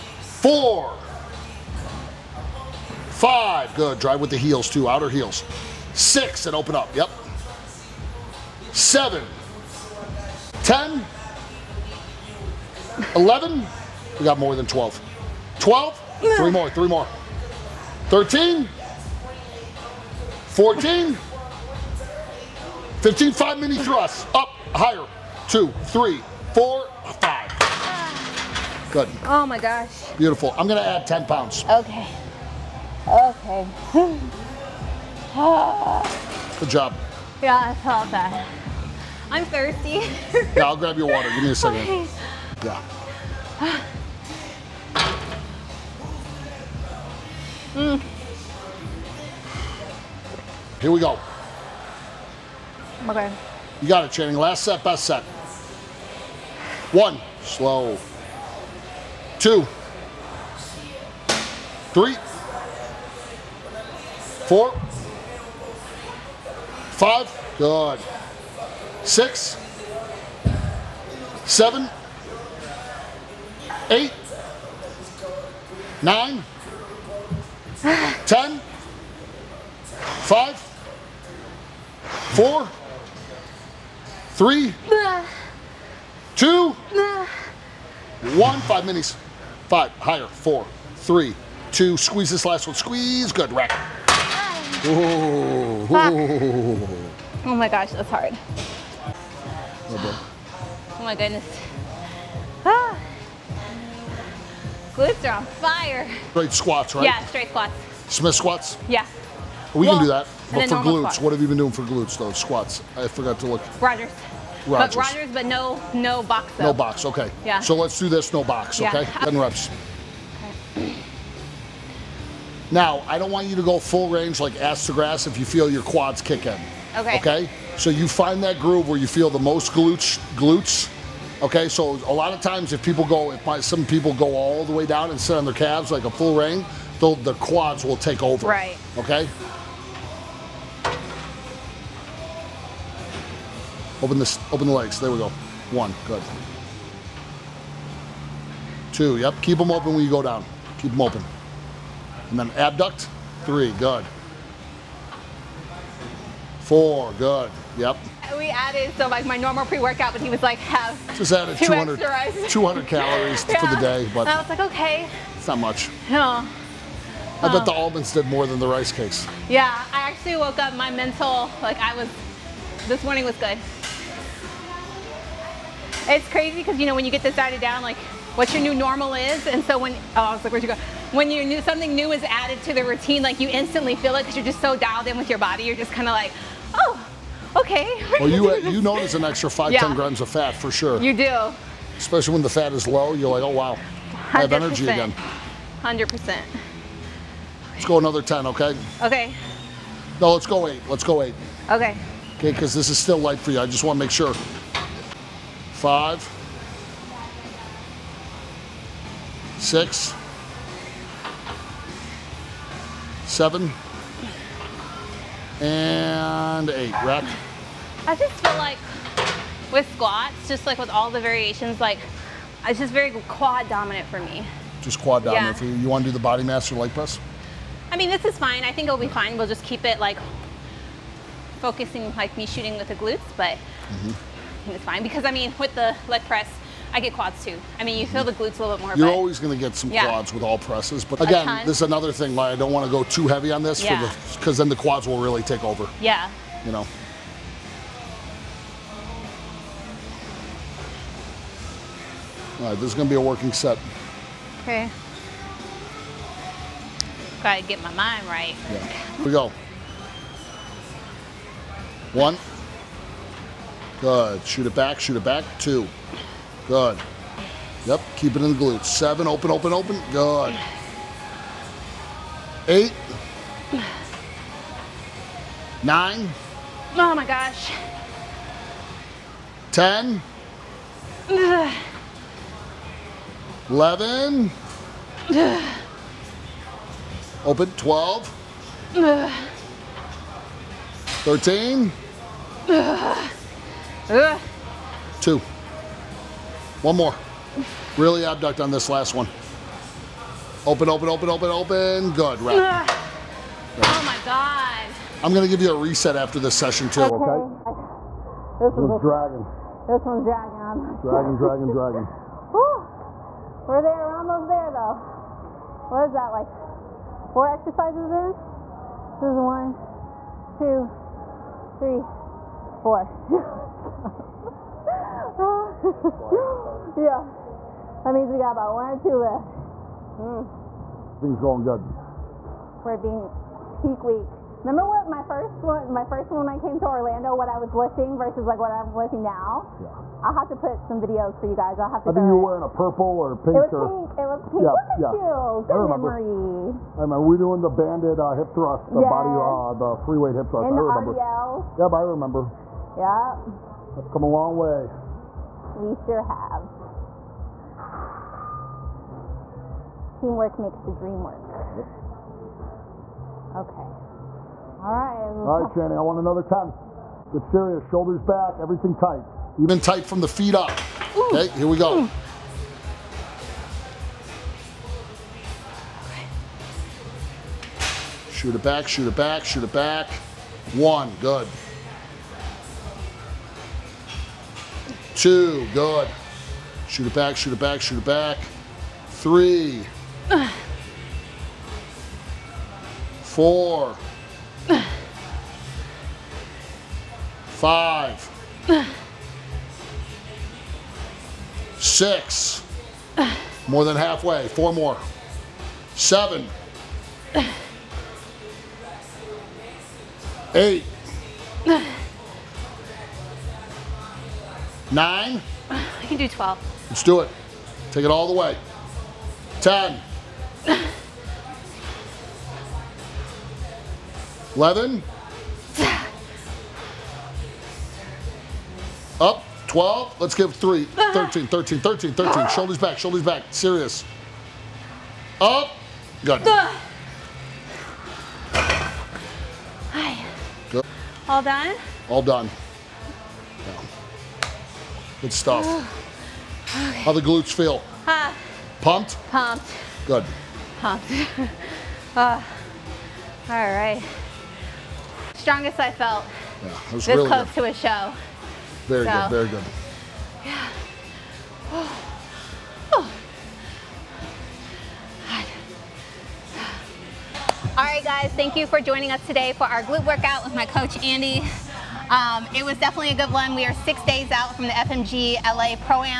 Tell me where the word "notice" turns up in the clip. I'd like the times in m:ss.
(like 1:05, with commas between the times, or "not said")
3:08.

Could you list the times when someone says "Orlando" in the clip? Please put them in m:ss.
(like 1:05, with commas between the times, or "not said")
5:36.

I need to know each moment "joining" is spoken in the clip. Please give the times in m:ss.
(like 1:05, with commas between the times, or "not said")
7:48.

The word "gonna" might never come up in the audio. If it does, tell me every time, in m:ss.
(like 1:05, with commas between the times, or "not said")
0:30, 5:05.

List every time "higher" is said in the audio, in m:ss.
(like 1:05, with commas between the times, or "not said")
0:24, 1:29.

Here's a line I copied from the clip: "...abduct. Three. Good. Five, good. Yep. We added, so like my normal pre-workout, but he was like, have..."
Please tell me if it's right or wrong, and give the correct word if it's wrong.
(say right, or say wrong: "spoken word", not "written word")
wrong: "Four", not "Five".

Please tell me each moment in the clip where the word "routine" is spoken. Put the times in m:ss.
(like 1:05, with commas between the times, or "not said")
3:02.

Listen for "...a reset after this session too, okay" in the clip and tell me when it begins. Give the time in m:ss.
5:05.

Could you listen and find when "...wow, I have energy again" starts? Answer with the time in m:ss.
3:13.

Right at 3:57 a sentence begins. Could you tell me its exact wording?
I mean, you feel the glutes a little bit more.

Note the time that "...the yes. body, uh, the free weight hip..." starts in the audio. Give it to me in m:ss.
5:48.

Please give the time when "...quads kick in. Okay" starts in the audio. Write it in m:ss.
2:05.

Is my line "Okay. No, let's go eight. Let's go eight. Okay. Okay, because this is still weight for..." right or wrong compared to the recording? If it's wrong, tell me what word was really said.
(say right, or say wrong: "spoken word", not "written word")
wrong: "light", not "weight".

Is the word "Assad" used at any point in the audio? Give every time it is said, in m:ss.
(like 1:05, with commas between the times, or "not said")
not said.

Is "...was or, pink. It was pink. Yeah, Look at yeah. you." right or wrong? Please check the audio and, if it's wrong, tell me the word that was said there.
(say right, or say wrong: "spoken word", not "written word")
right.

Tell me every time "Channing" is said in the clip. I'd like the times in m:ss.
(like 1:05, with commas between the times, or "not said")
0:54, 6:05.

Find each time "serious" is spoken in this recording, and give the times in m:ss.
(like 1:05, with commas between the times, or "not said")
6:07, 7:13.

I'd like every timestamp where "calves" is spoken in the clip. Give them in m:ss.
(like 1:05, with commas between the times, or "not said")
2:15.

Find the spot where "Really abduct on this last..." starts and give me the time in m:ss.
4:57.